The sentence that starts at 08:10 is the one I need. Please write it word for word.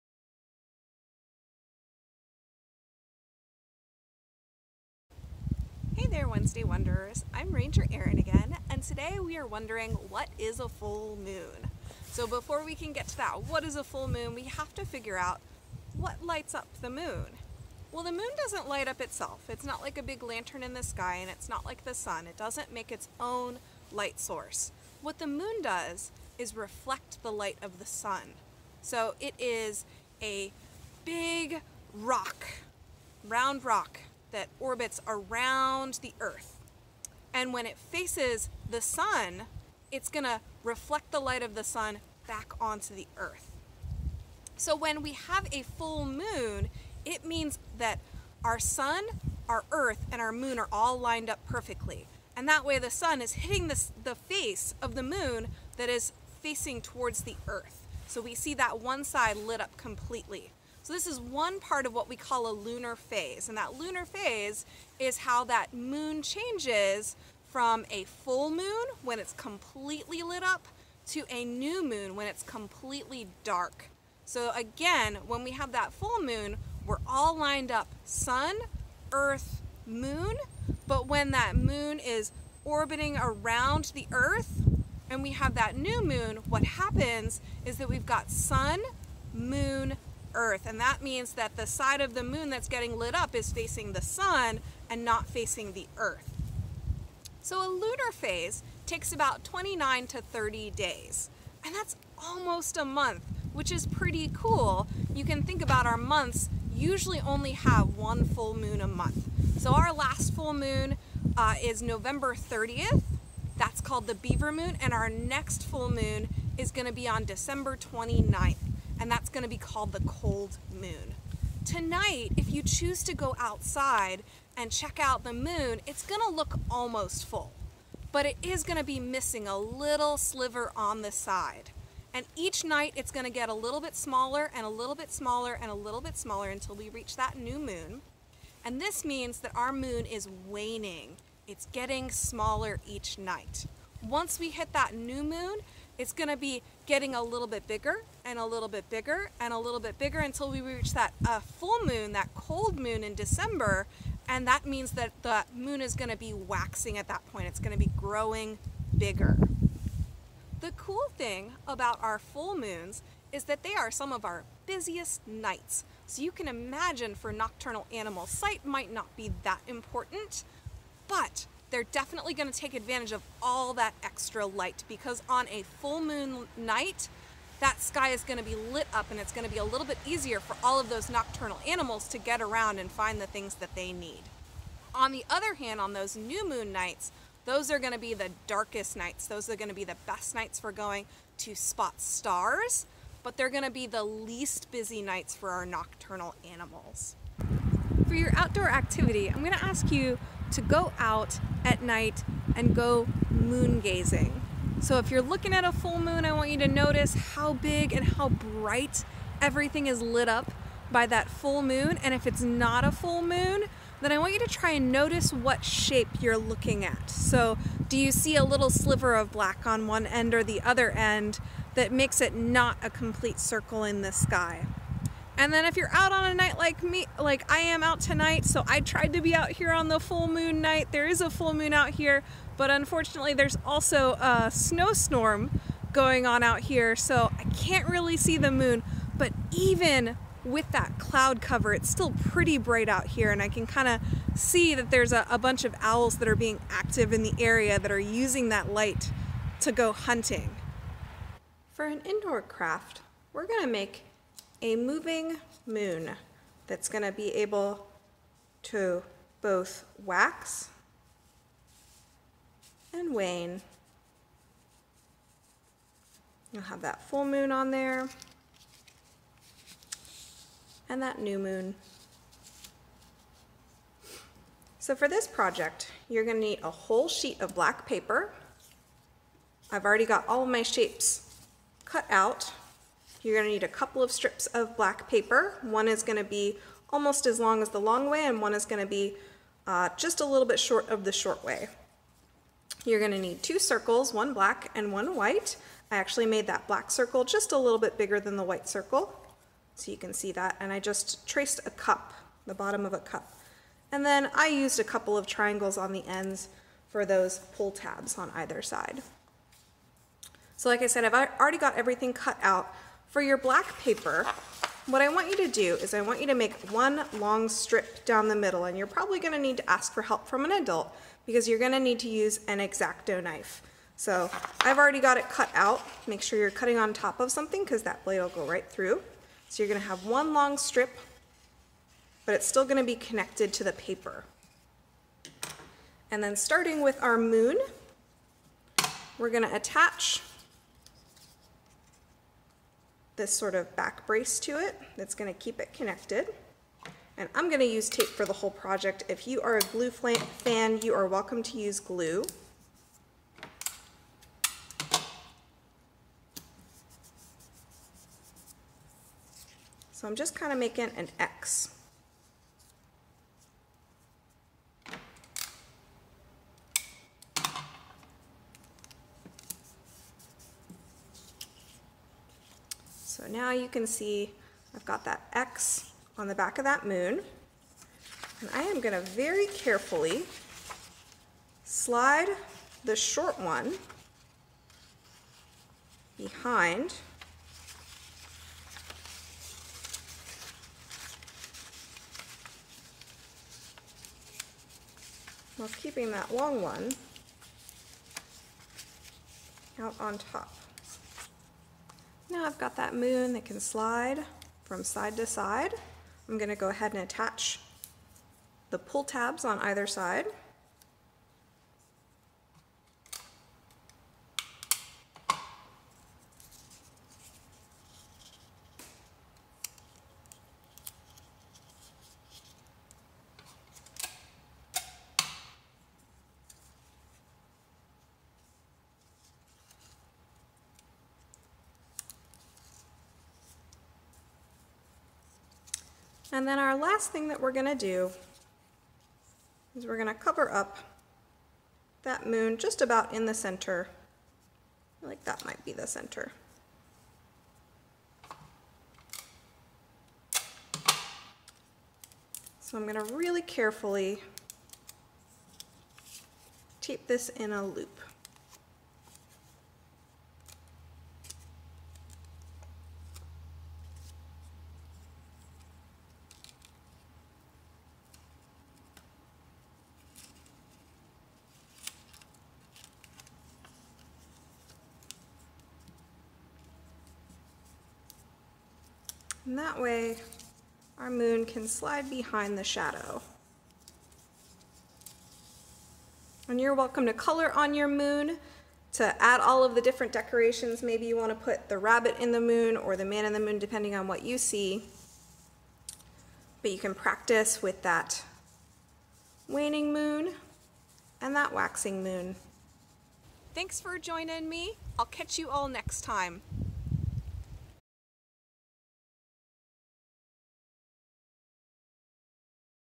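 Maybe you want to put the rabbit in the moon or the man in the moon, depending on what you see.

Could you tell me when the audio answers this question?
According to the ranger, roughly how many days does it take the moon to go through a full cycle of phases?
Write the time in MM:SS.
01:39.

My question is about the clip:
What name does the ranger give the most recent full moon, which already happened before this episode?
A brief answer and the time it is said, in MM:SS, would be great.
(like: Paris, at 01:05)
Beaver Moon, at 01:54.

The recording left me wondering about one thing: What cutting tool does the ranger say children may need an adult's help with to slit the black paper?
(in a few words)
X-Acto knife.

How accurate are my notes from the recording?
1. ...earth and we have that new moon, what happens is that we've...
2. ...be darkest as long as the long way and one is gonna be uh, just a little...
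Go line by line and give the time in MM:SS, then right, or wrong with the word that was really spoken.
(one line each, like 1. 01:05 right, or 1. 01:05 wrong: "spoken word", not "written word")
1. 01:24 right
2. 04:46 wrong: "almost", not "darkest".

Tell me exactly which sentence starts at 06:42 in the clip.
Now I've got that moon that can slide from side to side.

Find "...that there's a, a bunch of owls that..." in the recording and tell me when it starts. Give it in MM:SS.
04:04.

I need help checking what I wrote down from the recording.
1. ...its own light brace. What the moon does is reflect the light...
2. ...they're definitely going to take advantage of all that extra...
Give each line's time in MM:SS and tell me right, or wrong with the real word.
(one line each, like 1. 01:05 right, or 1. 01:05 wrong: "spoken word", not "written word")
1. 00:22 wrong: "source", not "brace"
2. 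02:51 right.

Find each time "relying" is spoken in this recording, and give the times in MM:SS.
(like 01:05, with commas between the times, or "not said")
not said.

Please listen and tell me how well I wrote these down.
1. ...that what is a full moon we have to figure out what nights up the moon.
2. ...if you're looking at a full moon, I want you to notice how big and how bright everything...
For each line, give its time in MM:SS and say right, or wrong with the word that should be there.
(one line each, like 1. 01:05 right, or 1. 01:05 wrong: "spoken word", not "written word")
1. 00:13 wrong: "lights", not "nights"
2. 03:24 right.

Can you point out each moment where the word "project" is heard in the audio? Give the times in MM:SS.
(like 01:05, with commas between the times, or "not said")
04:35, 05:48.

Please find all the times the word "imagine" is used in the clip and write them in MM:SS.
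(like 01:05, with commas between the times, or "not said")
02:46.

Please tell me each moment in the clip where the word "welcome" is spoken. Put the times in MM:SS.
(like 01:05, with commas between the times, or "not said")
05:51, 08:06.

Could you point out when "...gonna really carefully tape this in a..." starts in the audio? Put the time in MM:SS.
07:32.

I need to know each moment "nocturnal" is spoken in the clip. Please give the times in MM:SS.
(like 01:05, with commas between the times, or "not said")
02:47, 03:01, 03:15.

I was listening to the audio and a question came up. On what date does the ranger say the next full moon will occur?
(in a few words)
December 29th.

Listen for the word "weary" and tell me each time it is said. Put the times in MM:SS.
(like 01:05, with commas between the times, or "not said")
not said.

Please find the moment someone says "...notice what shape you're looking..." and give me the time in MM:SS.
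03:34.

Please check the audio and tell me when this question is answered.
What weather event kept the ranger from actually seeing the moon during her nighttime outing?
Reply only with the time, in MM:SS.
03:54.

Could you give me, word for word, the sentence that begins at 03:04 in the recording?
On the other hand, on those new moon nights, those are going to be the darkest nights.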